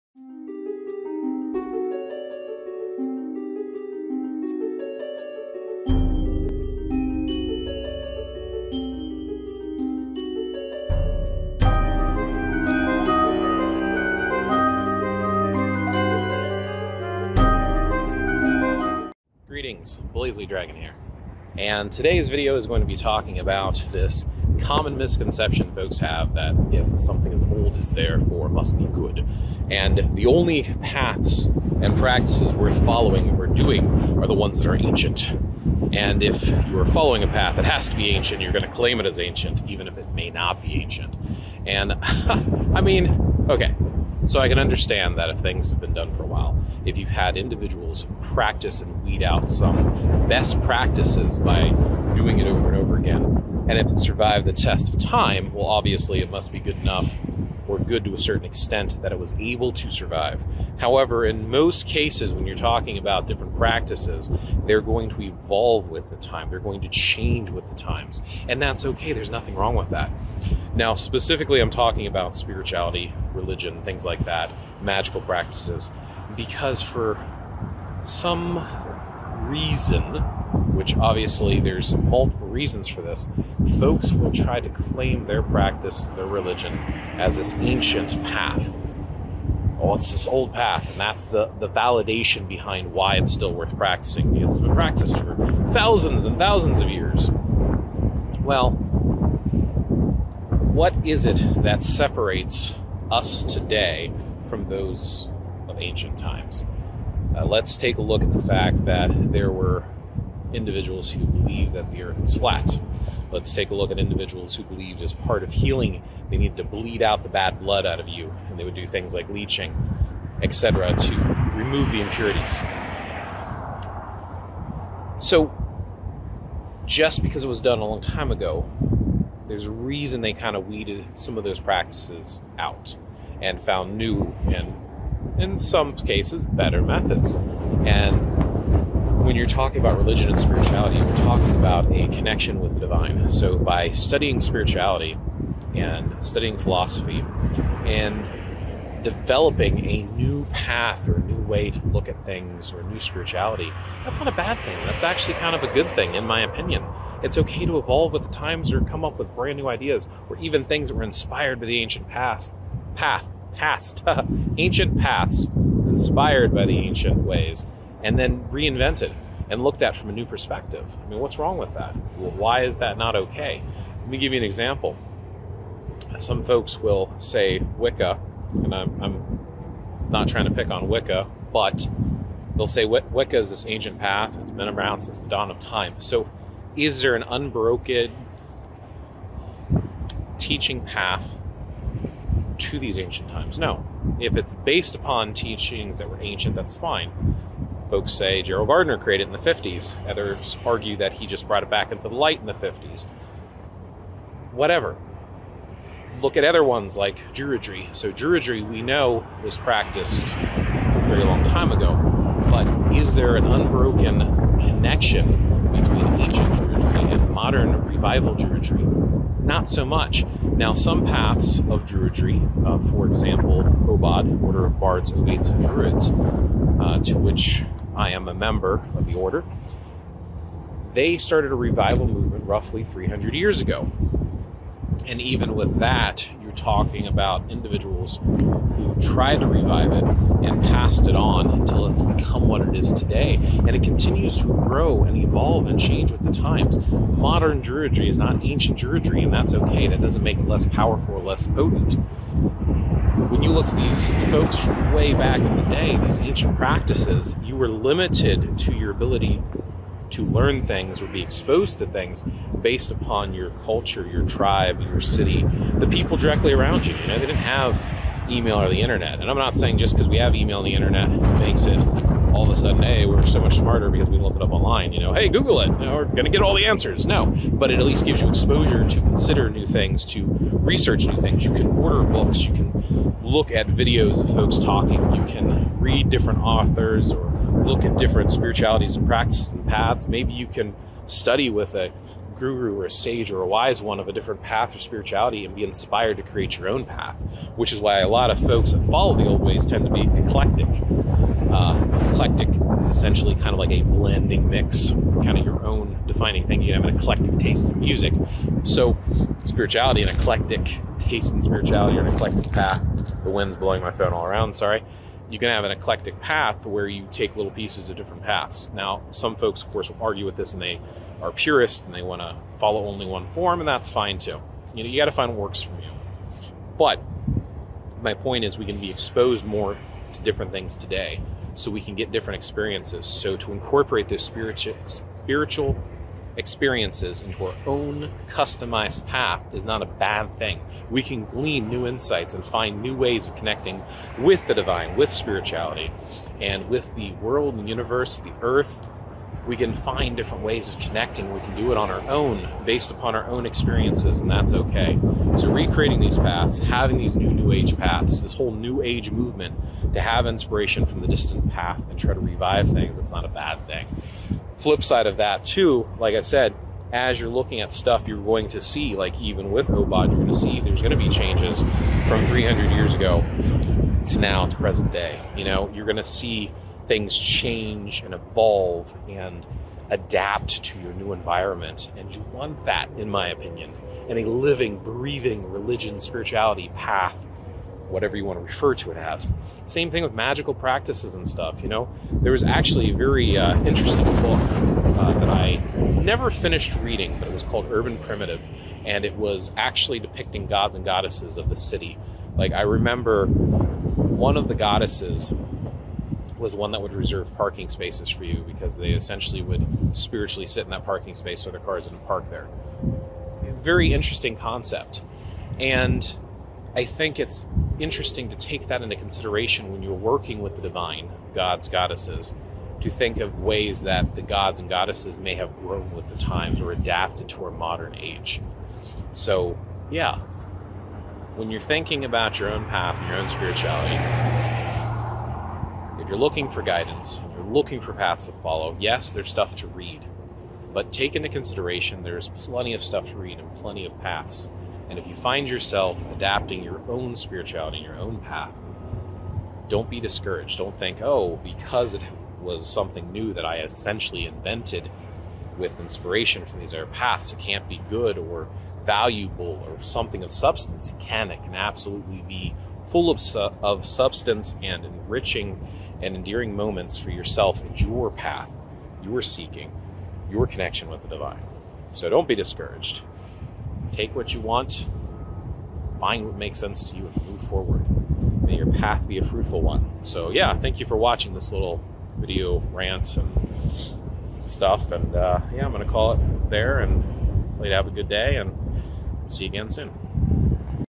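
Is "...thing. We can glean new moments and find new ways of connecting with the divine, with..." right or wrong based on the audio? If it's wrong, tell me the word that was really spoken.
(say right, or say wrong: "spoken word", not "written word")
wrong: "insights", not "moments".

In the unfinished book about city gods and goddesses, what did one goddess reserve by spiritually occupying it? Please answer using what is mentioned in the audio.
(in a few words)
parking spaces.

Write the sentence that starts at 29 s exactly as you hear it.
And the only paths and practices worth following or doing are the ones that are ancient.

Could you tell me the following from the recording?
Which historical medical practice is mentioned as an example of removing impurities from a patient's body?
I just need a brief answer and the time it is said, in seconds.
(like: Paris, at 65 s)
leeching, at 119 s.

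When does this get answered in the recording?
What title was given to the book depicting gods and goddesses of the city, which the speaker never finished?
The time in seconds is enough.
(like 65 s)
397 s.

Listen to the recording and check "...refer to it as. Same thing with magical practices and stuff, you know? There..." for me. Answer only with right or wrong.
right.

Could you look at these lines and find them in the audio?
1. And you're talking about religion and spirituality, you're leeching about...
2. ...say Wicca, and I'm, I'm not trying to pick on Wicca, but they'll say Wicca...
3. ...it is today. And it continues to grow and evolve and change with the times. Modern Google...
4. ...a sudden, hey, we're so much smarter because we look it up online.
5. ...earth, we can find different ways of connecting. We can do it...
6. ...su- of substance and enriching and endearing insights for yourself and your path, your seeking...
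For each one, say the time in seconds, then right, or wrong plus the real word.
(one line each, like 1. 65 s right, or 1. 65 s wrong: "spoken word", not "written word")
1. 137 s wrong: "talking", not "leeching"
2. 177 s right
3. 242 s wrong: "Druidry", not "Google"
4. 272 s right
5. 348 s right
6. 463 s wrong: "moments", not "insights".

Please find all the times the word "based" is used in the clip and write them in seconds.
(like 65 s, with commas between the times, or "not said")
194 s, 262 s, 352 s.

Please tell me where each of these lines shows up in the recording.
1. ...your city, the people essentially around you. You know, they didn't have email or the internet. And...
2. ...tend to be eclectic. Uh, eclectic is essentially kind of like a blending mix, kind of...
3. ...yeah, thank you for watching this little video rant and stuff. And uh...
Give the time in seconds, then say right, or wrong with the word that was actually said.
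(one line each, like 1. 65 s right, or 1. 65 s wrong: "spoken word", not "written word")
1. 264 s wrong: "directly", not "essentially"
2. 299 s right
3. 480 s right.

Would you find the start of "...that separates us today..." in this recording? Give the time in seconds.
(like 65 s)
101 s.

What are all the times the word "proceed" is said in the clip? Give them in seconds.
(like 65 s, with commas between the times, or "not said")
not said.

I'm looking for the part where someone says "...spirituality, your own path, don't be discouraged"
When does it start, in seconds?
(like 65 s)
447 s.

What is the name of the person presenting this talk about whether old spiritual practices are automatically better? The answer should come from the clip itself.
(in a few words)
Blaze Lee Dragon.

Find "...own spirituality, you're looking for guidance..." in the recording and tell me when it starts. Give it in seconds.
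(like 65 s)
433 s.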